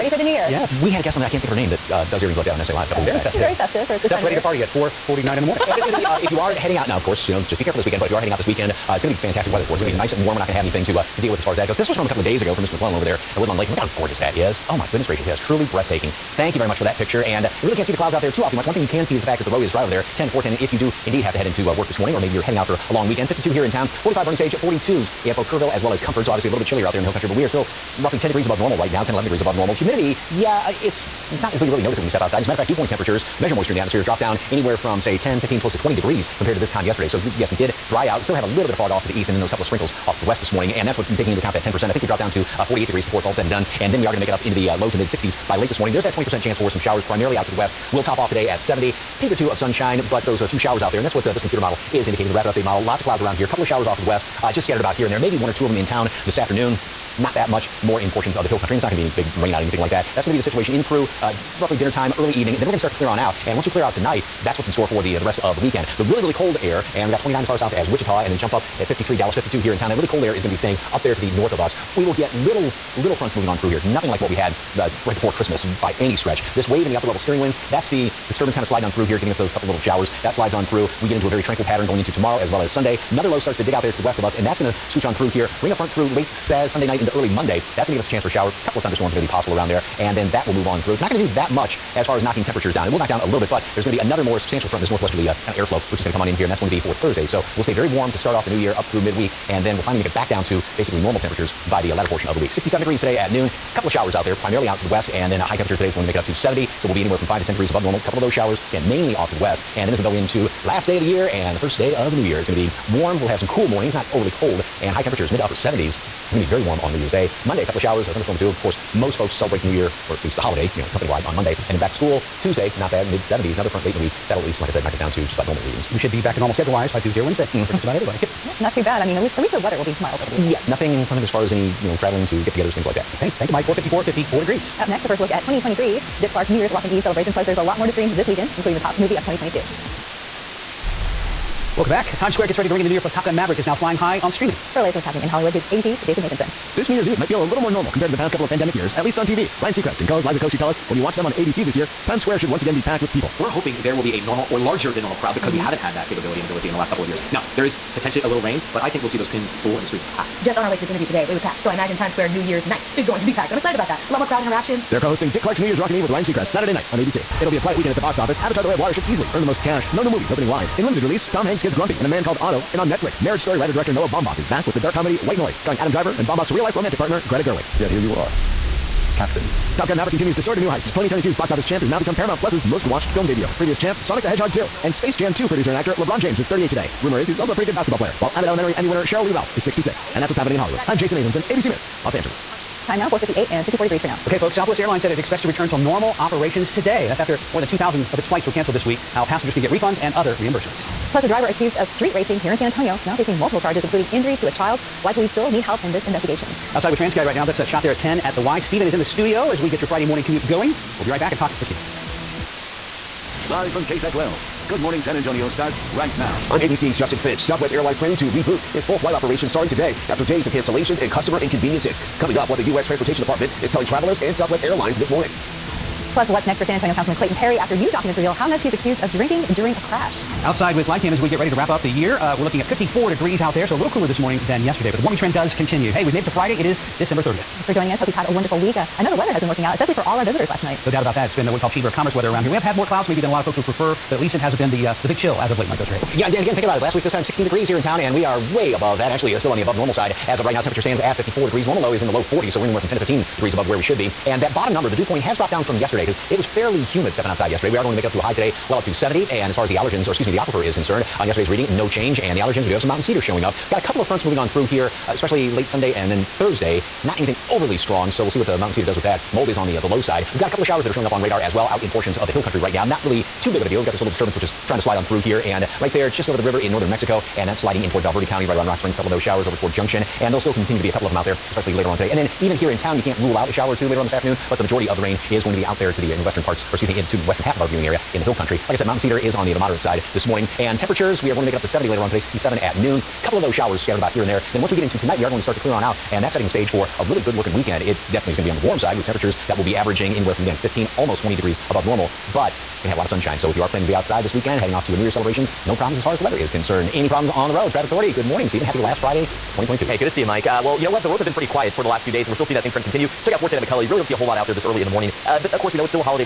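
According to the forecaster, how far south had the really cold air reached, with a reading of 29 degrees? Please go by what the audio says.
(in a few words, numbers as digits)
Wichita.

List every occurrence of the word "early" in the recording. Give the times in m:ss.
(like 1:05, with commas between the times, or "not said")
1:02, 1:27, 5:14.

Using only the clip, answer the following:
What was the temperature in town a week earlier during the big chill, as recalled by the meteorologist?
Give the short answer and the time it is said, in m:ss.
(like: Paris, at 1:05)
16 degrees, at 4:07.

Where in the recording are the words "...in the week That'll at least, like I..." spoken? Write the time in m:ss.
2:03.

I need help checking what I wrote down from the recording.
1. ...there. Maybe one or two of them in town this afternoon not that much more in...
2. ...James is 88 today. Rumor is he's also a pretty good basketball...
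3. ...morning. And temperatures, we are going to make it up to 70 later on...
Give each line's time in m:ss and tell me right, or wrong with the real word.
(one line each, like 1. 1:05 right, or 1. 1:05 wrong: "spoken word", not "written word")
1. 0:55 right
2. 3:06 wrong: "38", not "88"
3. 4:50 right.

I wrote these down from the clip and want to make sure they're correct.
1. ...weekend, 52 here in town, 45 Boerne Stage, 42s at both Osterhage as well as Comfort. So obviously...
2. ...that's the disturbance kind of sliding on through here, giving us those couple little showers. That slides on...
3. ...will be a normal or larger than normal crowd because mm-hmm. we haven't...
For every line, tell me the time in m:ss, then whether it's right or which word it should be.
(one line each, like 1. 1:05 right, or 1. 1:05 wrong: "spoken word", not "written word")
1. 0:23 wrong: "Kerrville", not "Osterhage"
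2. 1:17 right
3. 2:33 right.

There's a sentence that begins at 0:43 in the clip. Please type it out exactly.
And then we are going to make it up into the uh, low to mid 60s by late this morning.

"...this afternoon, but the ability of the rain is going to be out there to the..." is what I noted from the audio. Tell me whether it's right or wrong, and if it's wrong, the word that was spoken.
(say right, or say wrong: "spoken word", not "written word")
wrong: "majority", not "ability".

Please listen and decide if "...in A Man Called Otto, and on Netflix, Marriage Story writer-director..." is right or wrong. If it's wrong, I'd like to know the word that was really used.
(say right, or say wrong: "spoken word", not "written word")
right.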